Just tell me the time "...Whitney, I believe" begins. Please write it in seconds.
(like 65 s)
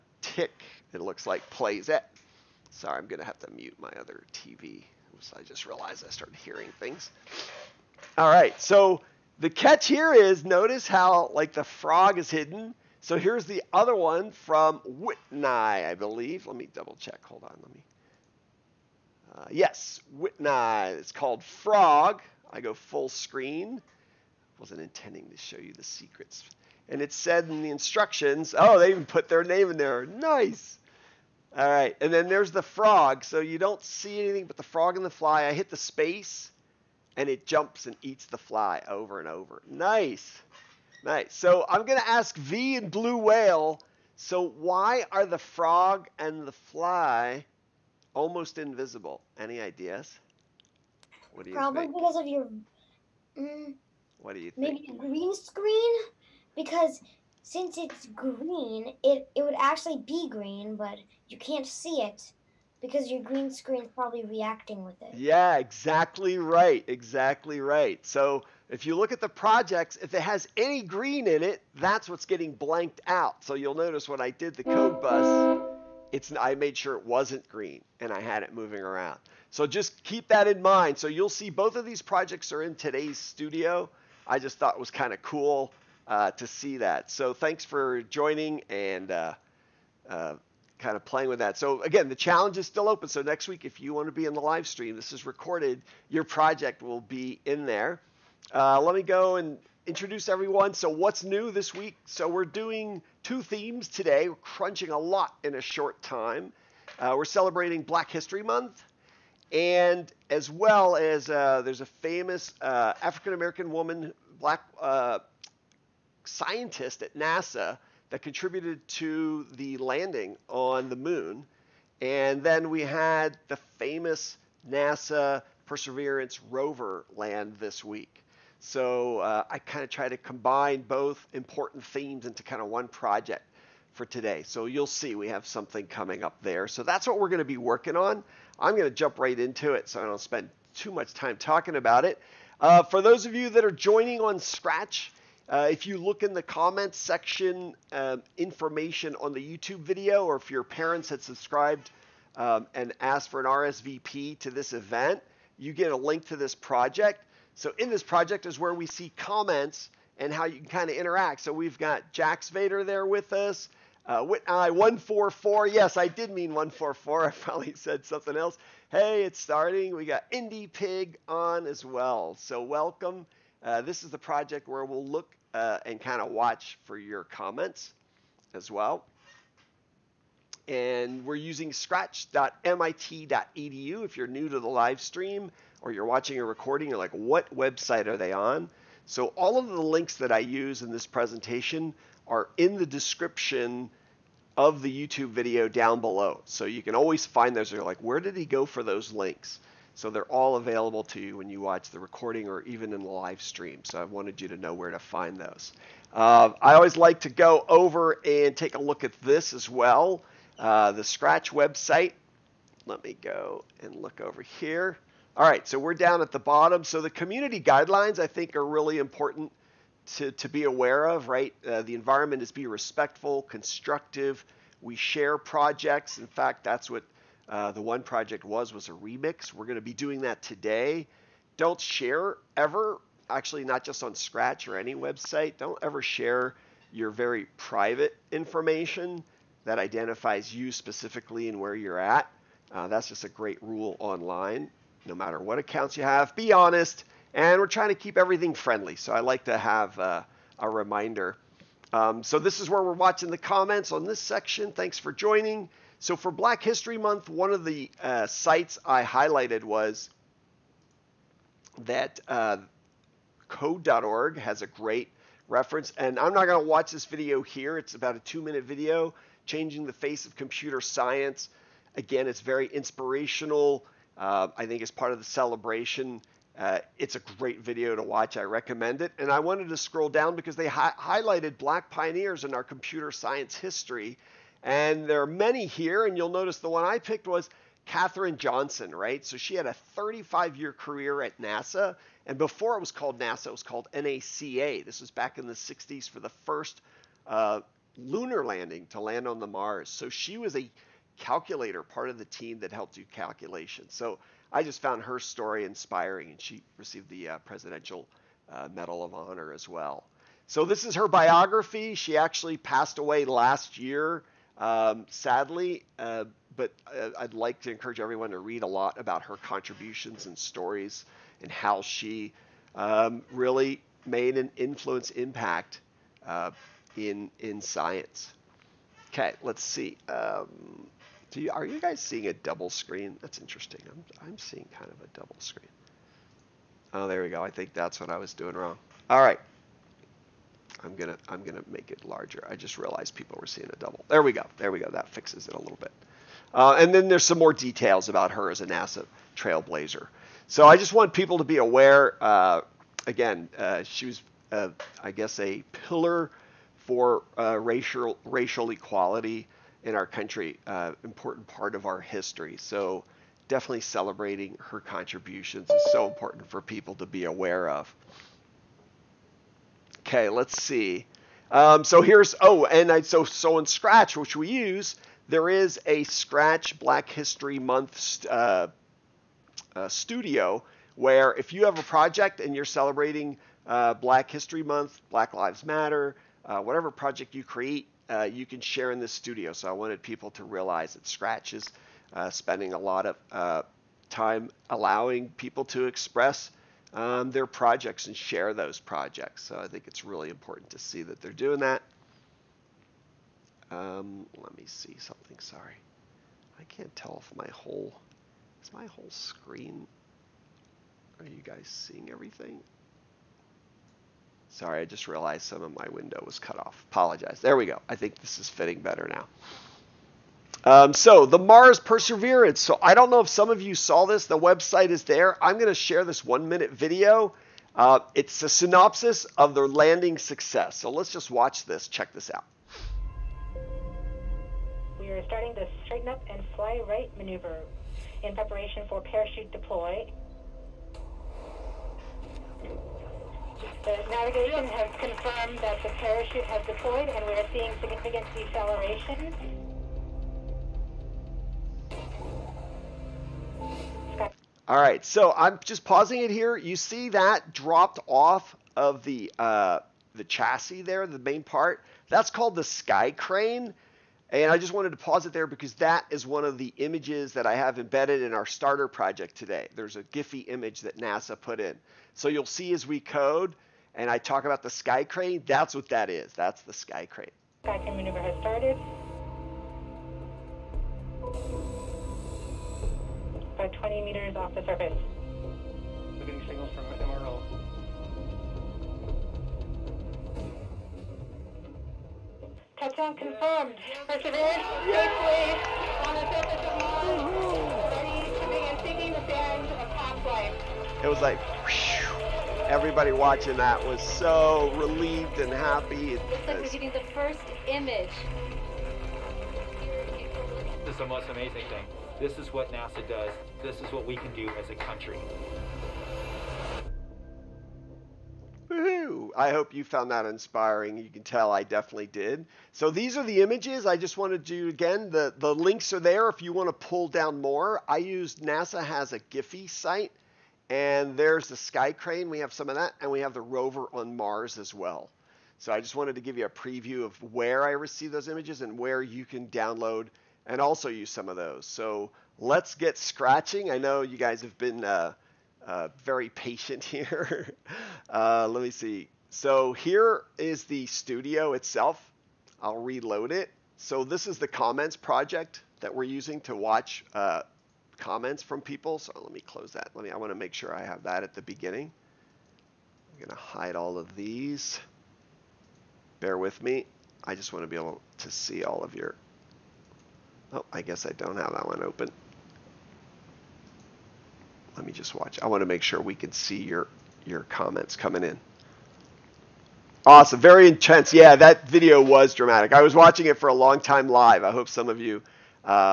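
14 s.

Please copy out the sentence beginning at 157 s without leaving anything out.
So in this project is where we see comments and how you can kind of interact.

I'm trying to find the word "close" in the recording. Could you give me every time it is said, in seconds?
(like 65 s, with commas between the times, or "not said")
559 s.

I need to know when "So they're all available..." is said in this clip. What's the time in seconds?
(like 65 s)
199 s.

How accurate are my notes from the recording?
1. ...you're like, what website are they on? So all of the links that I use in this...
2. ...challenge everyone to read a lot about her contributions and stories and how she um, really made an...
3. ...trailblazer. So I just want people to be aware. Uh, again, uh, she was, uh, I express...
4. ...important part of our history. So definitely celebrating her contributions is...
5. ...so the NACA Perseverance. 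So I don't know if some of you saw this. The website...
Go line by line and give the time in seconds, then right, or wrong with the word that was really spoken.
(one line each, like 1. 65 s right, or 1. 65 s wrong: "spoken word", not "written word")
1. 186 s right
2. 317 s wrong: "encourage", not "challenge"
3. 349 s wrong: "guess", not "express"
4. 361 s right
5. 420 s wrong: "Mars", not "NACA".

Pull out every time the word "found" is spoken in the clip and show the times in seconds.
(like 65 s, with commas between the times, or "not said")
304 s, 519 s.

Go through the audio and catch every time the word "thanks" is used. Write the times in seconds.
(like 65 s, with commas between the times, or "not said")
87 s, 254 s.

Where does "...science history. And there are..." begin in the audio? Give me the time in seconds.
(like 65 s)
283 s.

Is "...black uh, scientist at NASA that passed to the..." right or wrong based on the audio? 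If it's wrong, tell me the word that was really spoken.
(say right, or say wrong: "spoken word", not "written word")
wrong: "contributed", not "passed".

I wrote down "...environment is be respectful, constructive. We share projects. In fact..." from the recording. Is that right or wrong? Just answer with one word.
right.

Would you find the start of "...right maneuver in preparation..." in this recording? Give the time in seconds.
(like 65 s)
436 s.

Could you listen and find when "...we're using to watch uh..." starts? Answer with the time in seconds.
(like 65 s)
555 s.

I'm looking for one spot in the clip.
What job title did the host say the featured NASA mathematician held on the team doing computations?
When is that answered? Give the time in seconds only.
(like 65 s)
301 s.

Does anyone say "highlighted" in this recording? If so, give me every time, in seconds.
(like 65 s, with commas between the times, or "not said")
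259 s, 280 s.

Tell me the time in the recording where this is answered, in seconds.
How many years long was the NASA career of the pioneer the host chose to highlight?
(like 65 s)
289 s.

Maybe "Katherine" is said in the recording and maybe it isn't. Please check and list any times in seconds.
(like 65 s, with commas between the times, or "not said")
287 s.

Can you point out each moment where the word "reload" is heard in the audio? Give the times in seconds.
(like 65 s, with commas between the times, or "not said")
552 s.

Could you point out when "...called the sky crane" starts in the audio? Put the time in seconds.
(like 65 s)
462 s.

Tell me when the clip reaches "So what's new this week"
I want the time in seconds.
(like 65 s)
100 s.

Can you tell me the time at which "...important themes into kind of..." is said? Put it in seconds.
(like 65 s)
131 s.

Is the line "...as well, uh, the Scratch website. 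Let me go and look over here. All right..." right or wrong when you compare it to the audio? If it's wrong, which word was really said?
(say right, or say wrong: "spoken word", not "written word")
right.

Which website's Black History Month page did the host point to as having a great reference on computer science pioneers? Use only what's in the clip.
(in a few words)
code.org.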